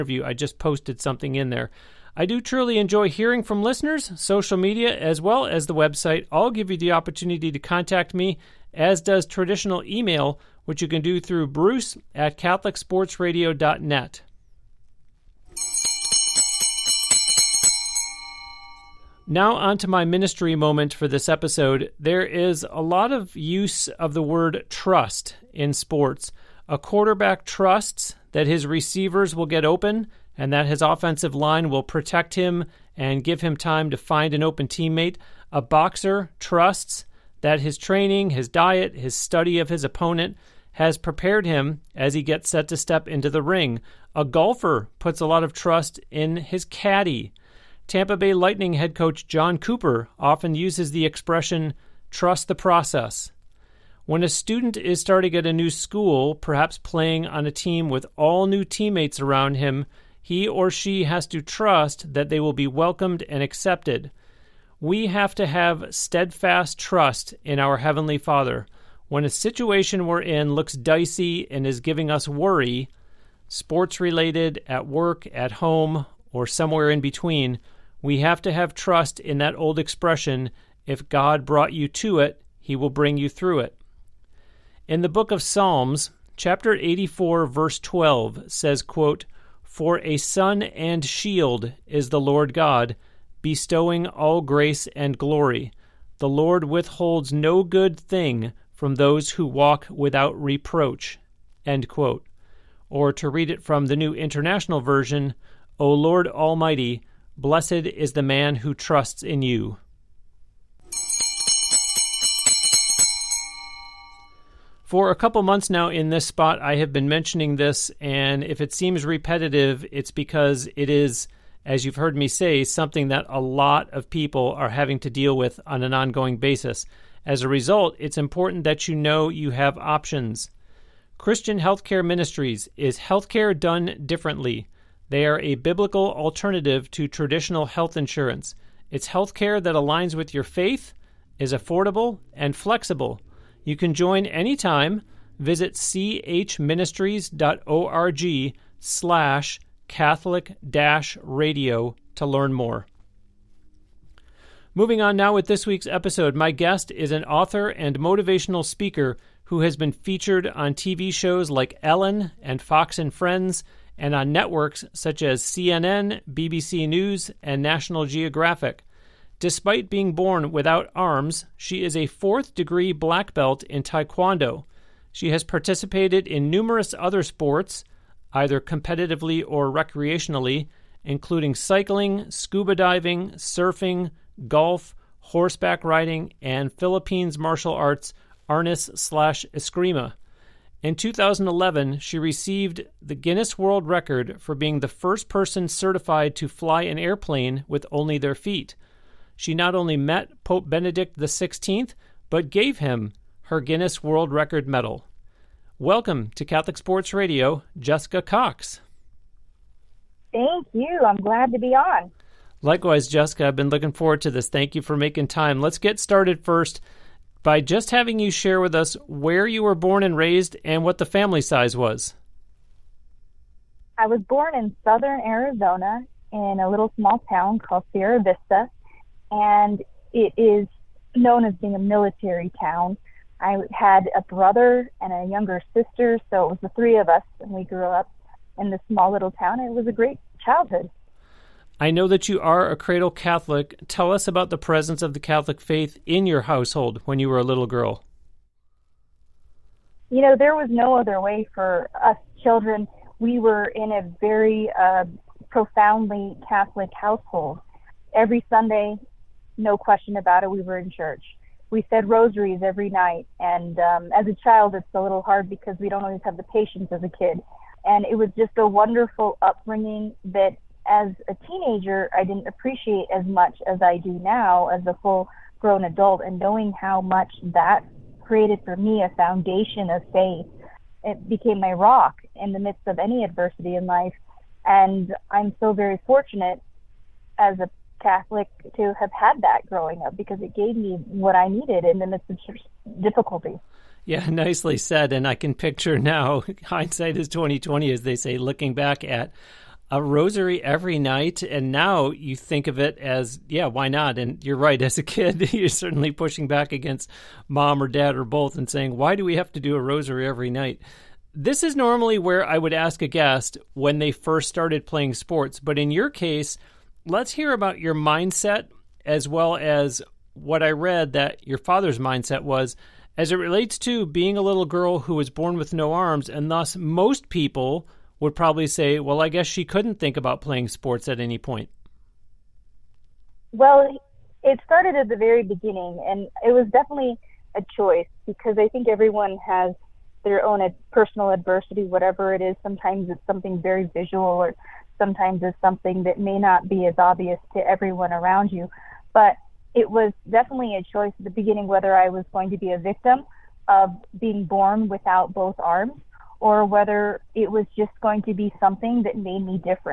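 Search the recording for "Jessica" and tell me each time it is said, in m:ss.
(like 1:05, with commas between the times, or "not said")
3:27, 3:33.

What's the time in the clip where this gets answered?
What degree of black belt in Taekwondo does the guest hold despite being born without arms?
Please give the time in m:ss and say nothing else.
2:52.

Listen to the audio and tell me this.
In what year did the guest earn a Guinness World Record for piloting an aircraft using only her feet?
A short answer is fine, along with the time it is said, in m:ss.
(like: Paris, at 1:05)
2011, at 3:10.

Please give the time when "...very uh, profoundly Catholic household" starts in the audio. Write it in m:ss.
4:14.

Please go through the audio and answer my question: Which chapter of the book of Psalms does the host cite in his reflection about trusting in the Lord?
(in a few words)
84.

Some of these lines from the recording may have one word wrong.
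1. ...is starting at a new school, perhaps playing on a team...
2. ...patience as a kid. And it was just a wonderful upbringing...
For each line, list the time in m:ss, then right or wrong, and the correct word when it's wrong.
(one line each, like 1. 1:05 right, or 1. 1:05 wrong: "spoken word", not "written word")
1. 0:54 right
2. 4:26 right.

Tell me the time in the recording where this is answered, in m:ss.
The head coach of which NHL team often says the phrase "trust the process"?
0:47.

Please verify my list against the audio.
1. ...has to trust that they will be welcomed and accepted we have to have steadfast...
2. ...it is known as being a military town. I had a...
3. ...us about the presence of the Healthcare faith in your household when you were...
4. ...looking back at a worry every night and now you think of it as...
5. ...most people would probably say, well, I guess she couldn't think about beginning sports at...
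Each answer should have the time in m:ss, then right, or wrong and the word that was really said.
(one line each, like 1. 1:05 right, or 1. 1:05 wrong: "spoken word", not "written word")
1. 1:01 right
2. 3:50 right
3. 4:04 wrong: "Catholic", not "Healthcare"
4. 4:58 wrong: "rosary", not "worry"
5. 5:26 wrong: "playing", not "beginning".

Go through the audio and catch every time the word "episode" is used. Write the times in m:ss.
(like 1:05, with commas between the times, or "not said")
0:21, 2:35.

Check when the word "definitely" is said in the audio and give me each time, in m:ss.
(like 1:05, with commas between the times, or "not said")
5:36, 5:50.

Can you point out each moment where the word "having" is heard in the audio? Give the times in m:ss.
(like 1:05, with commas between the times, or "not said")
2:04, 3:37.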